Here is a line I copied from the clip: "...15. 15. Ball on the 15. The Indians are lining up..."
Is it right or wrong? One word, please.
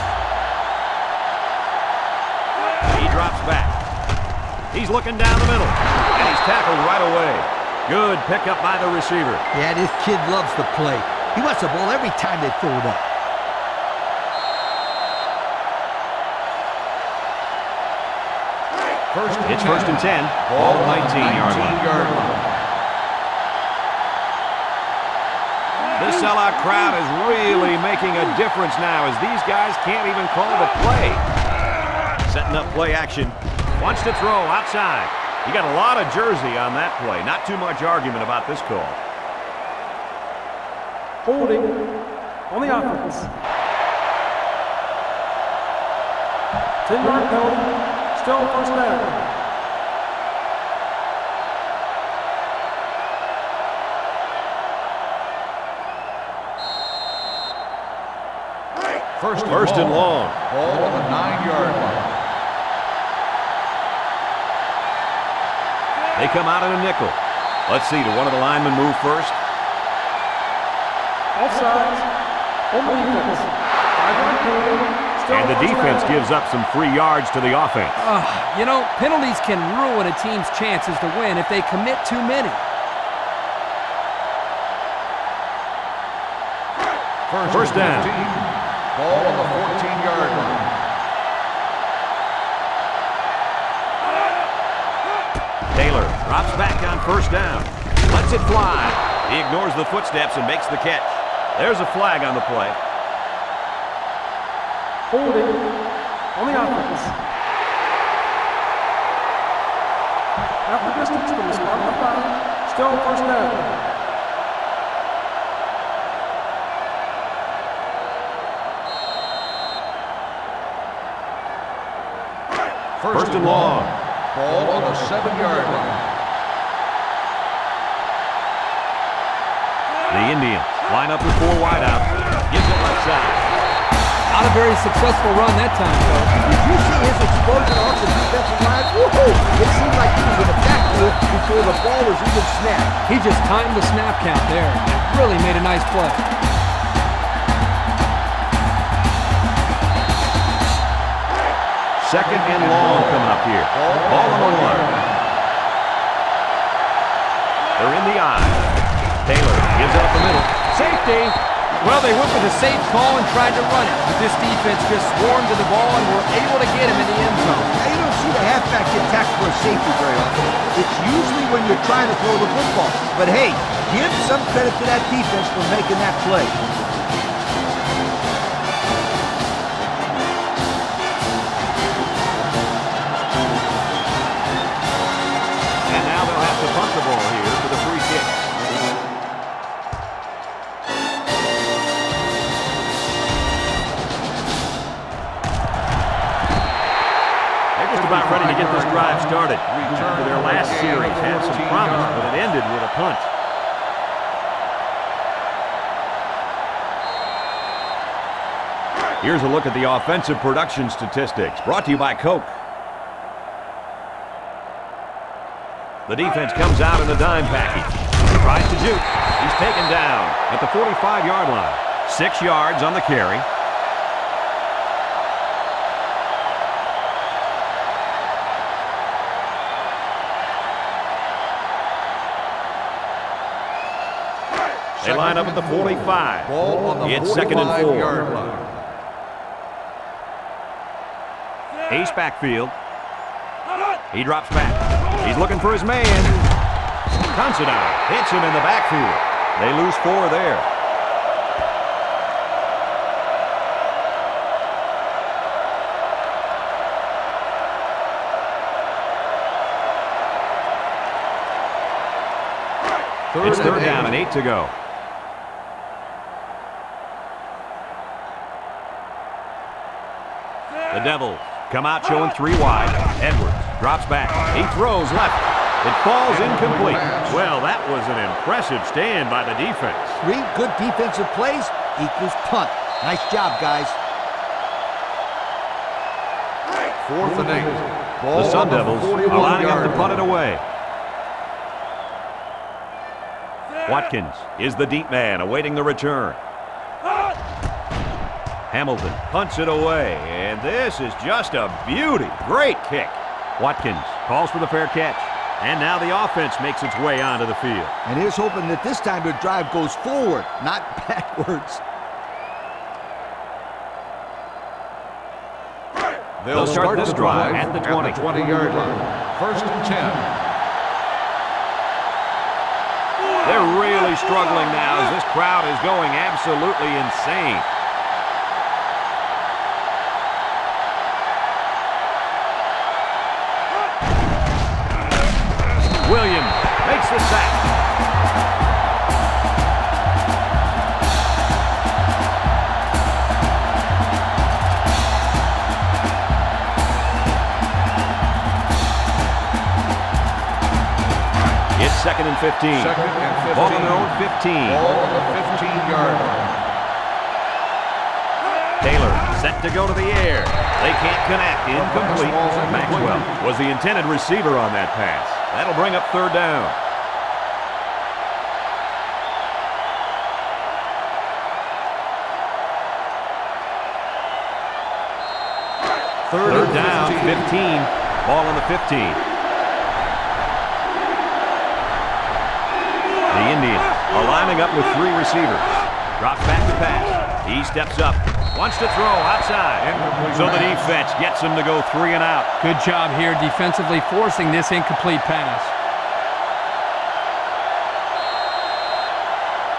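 right.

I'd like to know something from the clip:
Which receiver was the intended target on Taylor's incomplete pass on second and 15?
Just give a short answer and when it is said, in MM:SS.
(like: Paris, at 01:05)
Maxwell, at 06:02.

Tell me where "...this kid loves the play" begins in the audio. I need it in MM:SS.
00:09.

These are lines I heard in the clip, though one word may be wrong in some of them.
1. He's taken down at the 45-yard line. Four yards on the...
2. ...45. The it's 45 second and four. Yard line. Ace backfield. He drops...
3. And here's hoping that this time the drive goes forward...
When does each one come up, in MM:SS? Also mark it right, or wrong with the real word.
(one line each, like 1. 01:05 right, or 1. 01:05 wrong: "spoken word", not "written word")
1. 03:39 wrong: "Six", not "Four"
2. 03:55 right
3. 05:08 right.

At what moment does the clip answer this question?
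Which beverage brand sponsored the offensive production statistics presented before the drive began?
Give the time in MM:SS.
03:32.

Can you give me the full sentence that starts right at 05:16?
They'll, start, start this drive, drive at the 20.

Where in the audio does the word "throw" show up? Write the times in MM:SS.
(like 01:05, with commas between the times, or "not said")
00:12, 00:34, 02:52, 04:34, 06:28.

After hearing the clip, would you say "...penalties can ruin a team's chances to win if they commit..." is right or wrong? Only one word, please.
right.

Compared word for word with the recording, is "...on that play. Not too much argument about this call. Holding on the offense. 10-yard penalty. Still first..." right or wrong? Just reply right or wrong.
right.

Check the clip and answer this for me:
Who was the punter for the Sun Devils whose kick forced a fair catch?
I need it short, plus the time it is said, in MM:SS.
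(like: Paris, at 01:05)
Hamilton, at 04:58.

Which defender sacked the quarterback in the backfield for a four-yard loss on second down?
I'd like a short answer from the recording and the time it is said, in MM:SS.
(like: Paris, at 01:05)
Considine, at 04:07.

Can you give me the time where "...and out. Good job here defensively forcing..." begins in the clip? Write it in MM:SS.
06:32.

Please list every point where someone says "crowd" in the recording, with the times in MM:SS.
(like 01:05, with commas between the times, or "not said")
00:26, 05:25.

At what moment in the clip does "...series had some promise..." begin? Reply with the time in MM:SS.
03:20.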